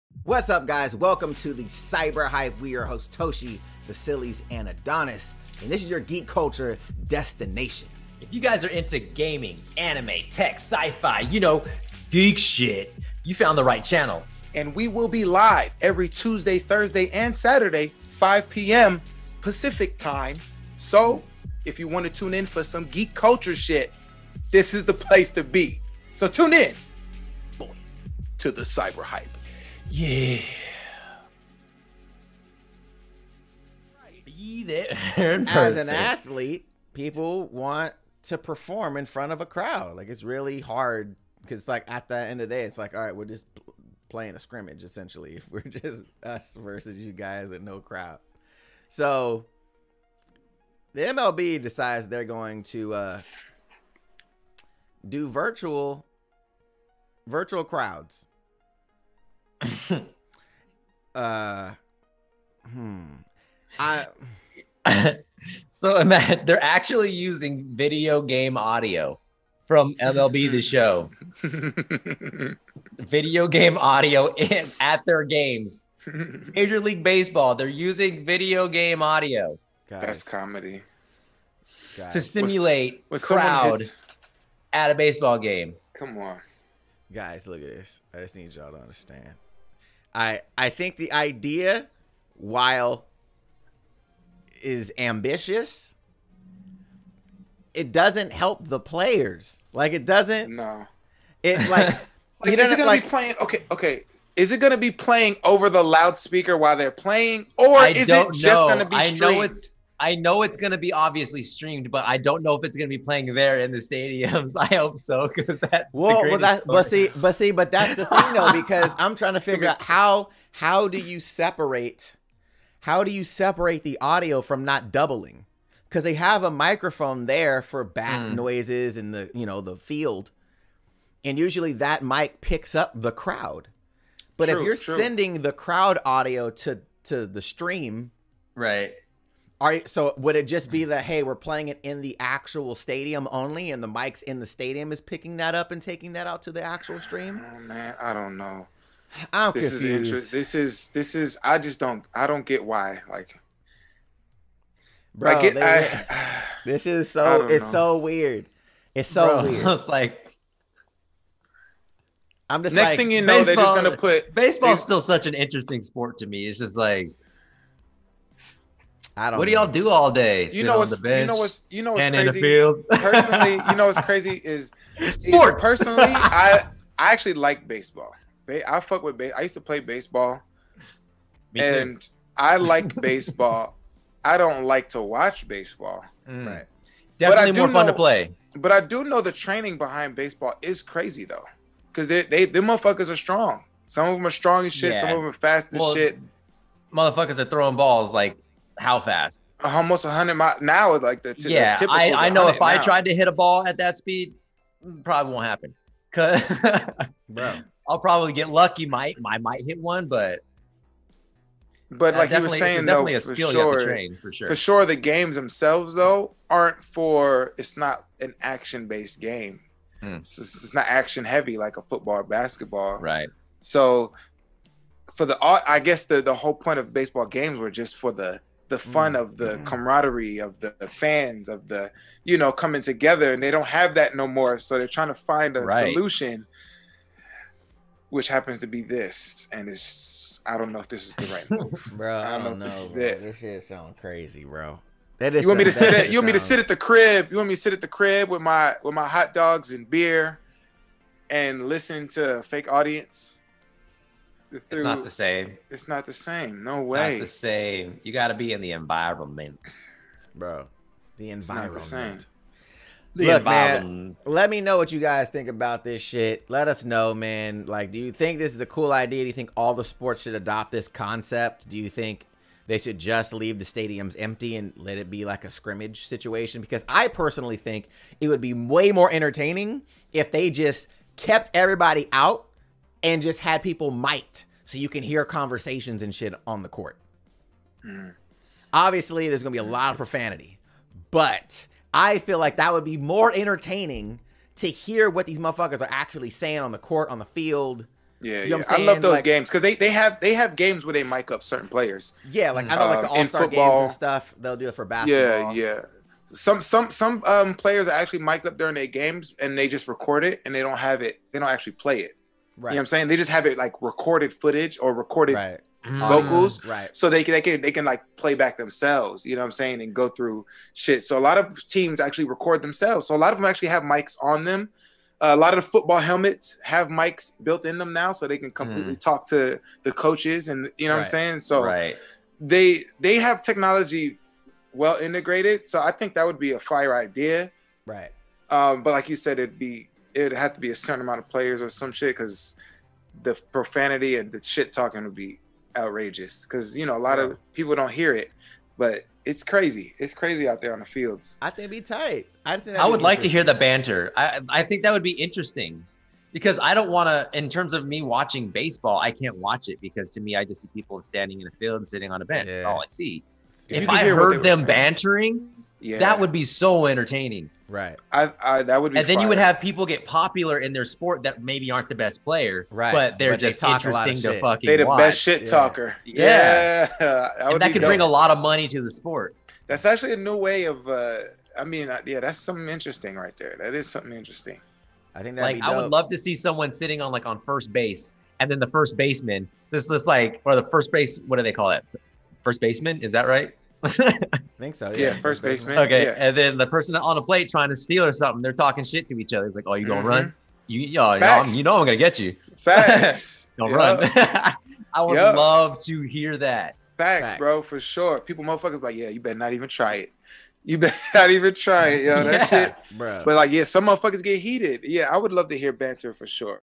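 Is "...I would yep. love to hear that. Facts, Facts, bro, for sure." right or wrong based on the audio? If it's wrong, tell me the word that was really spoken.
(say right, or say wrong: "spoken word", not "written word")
right.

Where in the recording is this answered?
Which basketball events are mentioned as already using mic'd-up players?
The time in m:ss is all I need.
5:03.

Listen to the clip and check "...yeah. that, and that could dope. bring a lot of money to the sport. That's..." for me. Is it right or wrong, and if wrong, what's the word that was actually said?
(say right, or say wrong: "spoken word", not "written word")
right.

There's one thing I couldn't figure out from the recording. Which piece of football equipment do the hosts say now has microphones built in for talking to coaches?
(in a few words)
helmets.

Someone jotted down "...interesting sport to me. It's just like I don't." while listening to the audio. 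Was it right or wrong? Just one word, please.
right.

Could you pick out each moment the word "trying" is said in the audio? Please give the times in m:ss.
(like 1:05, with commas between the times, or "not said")
1:59, 3:54, 6:37.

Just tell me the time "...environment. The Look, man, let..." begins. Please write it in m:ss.
4:21.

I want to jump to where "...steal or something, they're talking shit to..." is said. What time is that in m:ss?
6:37.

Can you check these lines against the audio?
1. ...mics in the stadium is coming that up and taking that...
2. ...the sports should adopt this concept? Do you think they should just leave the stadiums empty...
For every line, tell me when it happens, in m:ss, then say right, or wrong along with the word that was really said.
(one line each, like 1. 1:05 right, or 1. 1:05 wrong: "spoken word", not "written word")
1. 2:23 wrong: "picking", not "coming"
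2. 4:29 right.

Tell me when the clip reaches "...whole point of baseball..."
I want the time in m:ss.
3:46.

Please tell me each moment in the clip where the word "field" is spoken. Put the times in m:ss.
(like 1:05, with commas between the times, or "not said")
2:09, 2:52, 4:57, 5:50, 6:01.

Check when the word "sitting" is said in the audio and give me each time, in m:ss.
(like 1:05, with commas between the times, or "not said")
6:01, 6:26.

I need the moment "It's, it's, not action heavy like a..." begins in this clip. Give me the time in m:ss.
3:40.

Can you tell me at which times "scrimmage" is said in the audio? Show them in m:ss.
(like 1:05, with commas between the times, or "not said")
0:44, 4:35.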